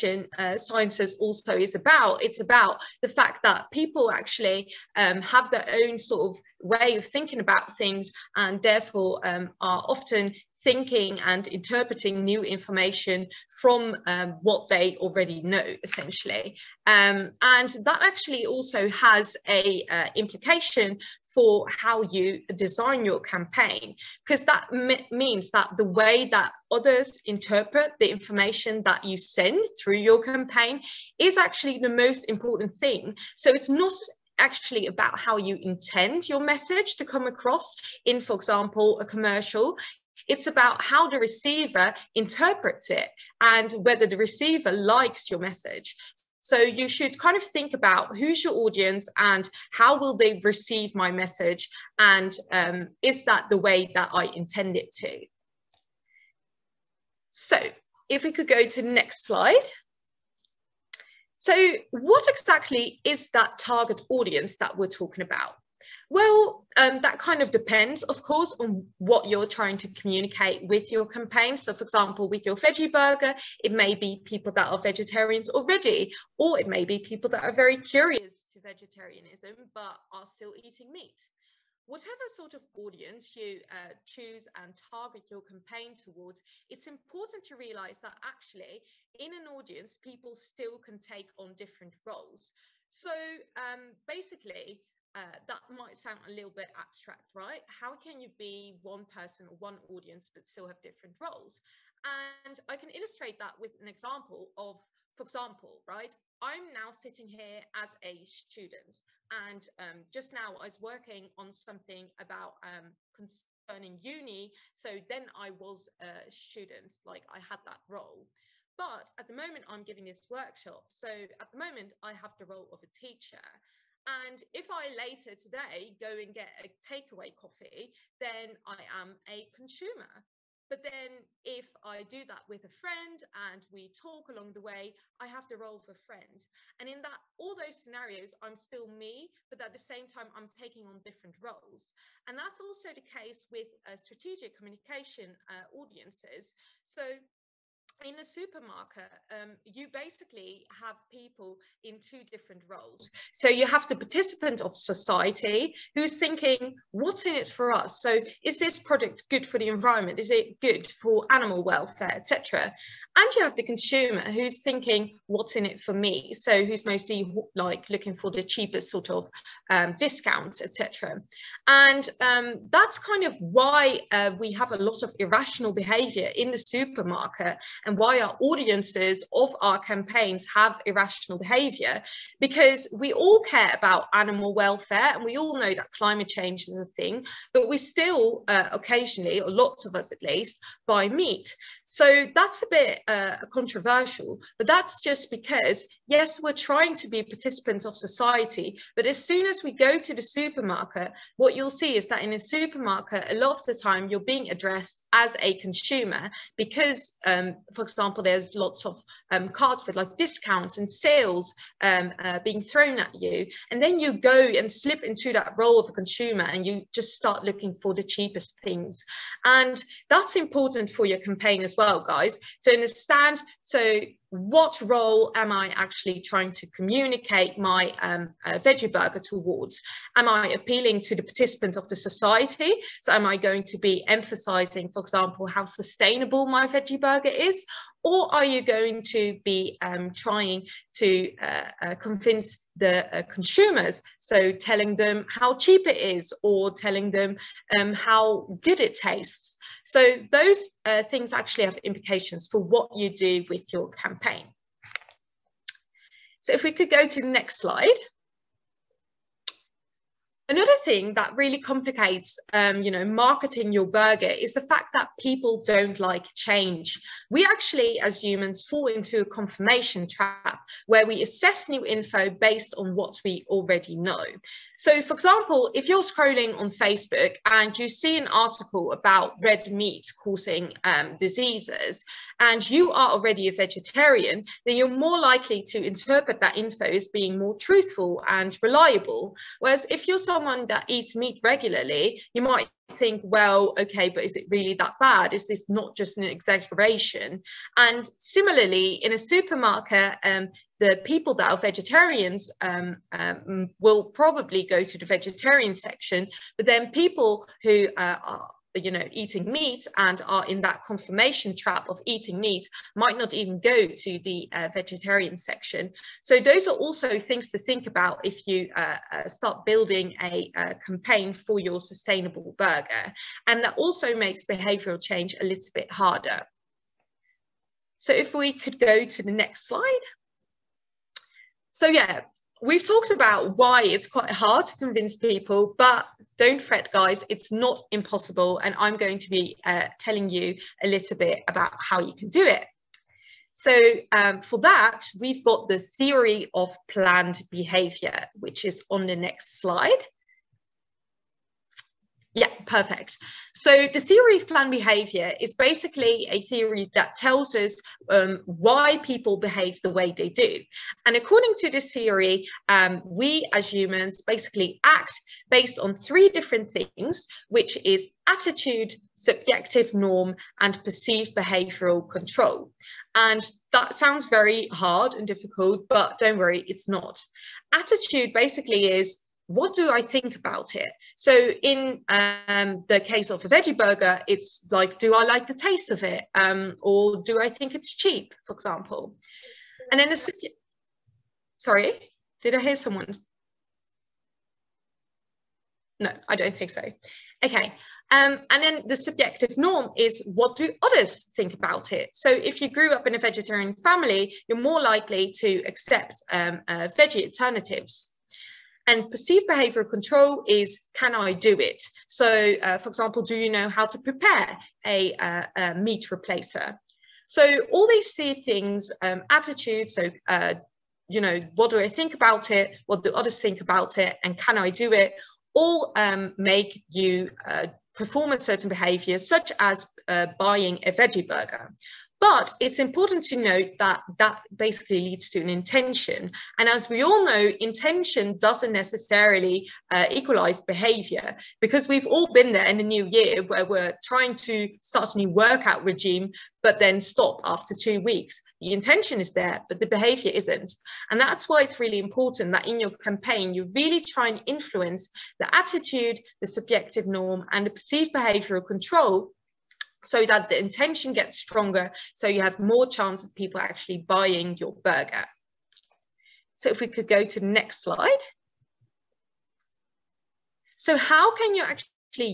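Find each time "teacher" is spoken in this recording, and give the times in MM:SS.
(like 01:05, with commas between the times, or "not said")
02:02.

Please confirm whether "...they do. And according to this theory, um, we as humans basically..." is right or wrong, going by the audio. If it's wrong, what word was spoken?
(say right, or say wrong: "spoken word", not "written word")
right.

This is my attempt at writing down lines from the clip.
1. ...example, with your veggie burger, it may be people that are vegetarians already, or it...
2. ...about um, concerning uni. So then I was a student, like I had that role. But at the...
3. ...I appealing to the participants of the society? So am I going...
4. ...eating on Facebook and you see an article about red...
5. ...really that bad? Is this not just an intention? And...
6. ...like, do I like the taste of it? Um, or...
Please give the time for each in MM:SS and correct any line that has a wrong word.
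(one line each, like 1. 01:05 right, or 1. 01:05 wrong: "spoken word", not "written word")
1. 01:11 right
2. 01:52 right
3. 03:50 right
4. 04:36 wrong: "scrolling", not "eating"
5. 04:54 wrong: "exaggeration", not "intention"
6. 06:24 right.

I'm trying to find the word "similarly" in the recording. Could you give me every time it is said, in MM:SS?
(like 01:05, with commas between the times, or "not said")
04:58.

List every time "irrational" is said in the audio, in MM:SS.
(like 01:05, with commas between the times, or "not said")
02:55, 03:00.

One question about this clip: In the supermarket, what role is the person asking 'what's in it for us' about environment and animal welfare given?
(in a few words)
participant of society.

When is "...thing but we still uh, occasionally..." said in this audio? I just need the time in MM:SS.
03:06.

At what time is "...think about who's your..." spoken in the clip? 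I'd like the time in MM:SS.
00:47.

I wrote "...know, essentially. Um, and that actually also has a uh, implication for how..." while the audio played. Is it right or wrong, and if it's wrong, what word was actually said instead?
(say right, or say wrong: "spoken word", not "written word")
right.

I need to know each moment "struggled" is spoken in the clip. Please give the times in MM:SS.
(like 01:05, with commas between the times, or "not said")
not said.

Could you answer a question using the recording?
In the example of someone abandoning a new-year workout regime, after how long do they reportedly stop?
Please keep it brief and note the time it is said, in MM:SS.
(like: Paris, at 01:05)
2 weeks, at 07:27.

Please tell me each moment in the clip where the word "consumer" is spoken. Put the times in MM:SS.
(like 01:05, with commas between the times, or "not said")
02:09, 02:43, 03:25, 03:35, 04:03.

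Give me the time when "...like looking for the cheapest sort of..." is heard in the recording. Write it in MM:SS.
02:47.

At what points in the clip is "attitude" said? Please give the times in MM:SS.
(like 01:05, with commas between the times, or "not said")
06:08, 06:17, 06:59, 07:35.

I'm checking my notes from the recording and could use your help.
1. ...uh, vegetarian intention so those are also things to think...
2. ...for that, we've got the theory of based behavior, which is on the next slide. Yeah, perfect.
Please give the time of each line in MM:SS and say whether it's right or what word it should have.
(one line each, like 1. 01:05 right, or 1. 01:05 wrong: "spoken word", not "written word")
1. 05:14 wrong: "section", not "intention"
2. 05:44 wrong: "planned", not "based".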